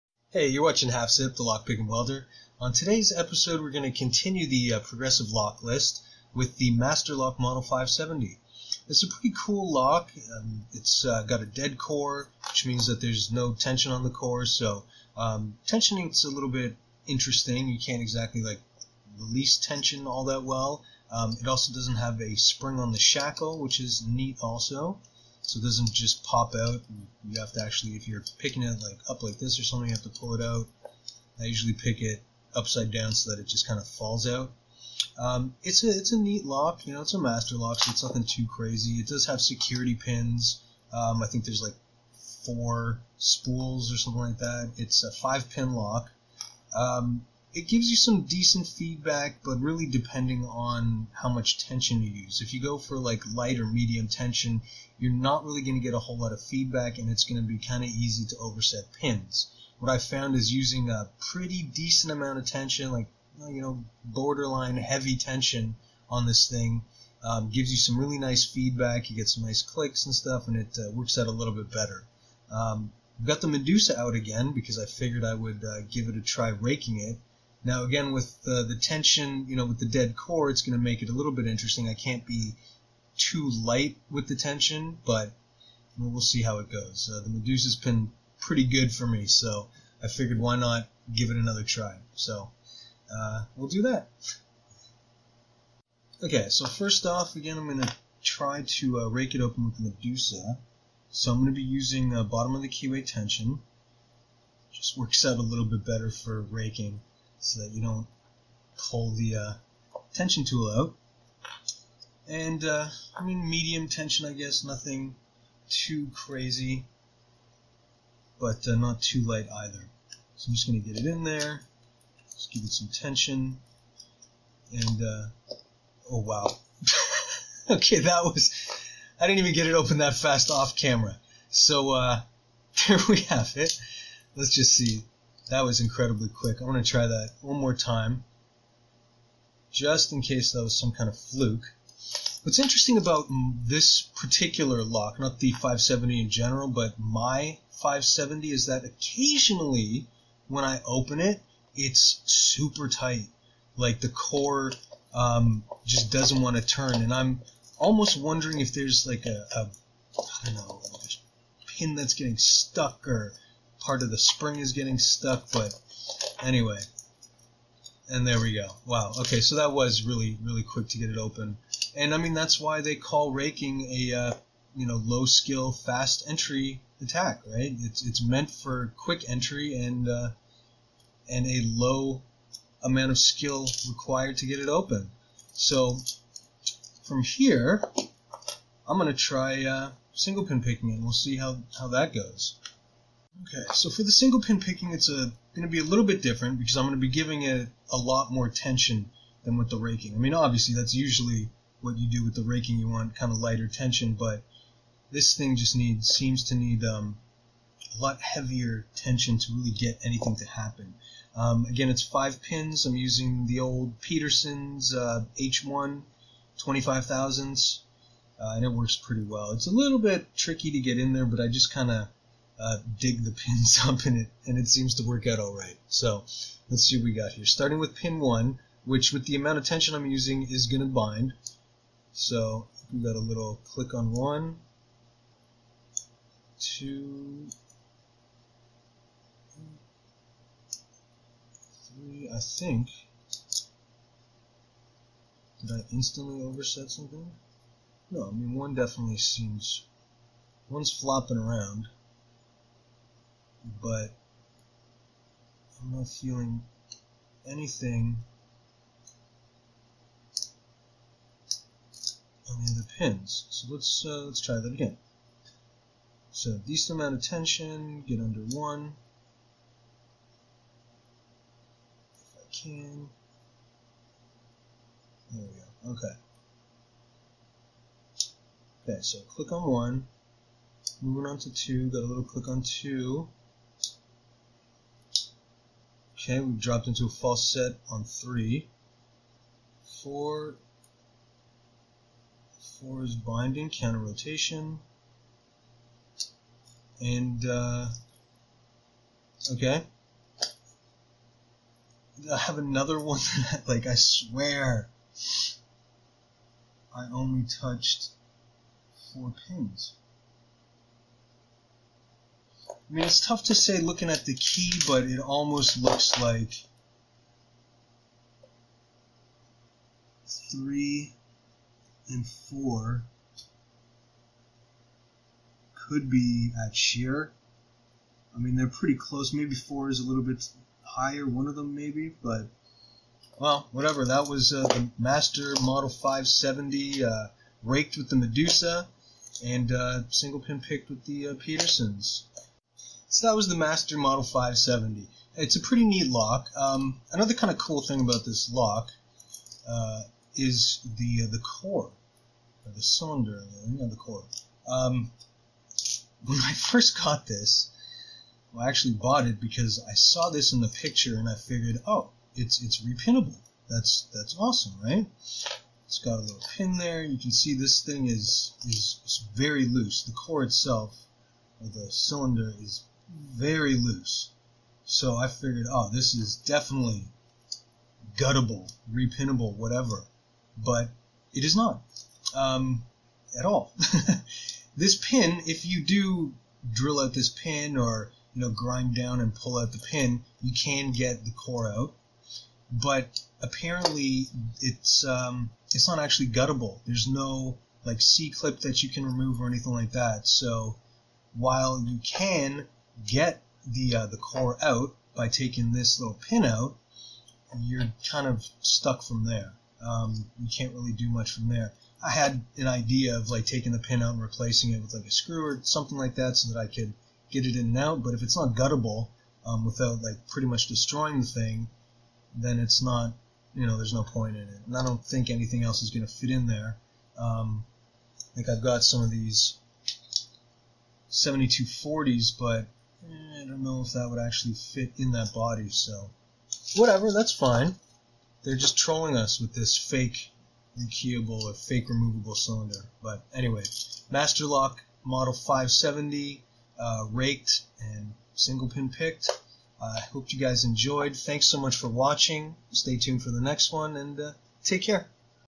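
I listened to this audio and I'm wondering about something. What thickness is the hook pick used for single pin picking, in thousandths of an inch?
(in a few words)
25 thousandths.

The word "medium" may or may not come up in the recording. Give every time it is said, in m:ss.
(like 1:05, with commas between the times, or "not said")
0:53, 1:53.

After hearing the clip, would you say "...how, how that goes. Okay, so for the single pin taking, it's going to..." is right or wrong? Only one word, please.
wrong.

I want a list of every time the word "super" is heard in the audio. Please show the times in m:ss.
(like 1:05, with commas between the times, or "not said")
2:32.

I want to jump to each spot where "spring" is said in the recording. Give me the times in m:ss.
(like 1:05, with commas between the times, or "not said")
0:22, 2:44.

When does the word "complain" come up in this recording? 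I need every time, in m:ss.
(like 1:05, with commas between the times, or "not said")
not said.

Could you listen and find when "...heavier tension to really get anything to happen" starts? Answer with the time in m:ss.
3:28.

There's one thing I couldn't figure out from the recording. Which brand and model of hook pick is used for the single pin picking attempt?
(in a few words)
Peterson's H1.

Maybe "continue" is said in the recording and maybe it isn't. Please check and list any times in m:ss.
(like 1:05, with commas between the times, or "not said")
0:03.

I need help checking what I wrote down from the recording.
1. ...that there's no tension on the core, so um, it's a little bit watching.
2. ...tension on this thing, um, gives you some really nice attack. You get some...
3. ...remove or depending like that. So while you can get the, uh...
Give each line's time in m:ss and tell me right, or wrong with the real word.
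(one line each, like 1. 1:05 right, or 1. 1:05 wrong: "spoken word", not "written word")
1. 0:12 wrong: "interesting", not "watching"
2. 1:05 wrong: "feedback", not "attack"
3. 6:39 wrong: "anything", not "depending".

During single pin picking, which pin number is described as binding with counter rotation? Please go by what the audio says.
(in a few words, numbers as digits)
4.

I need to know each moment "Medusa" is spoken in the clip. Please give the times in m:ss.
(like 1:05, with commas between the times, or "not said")
1:13, 1:27, 1:39, 5:38.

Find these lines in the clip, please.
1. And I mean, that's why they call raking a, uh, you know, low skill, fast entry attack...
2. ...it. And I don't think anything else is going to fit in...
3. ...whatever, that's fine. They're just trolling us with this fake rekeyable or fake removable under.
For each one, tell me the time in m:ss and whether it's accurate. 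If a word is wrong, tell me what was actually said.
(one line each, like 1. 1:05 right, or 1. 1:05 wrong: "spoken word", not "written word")
1. 2:51 right
2. 7:04 right
3. 7:16 wrong: "cylinder", not "under".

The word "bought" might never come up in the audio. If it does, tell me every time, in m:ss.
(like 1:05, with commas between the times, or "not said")
5:58.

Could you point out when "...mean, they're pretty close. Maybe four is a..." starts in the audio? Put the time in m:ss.
5:28.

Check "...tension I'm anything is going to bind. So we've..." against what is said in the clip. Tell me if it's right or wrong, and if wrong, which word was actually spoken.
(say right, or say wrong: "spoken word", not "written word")
wrong: "using", not "anything".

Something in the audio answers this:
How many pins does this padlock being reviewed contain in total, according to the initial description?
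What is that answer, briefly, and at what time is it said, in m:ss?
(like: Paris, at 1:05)
5, at 0:44.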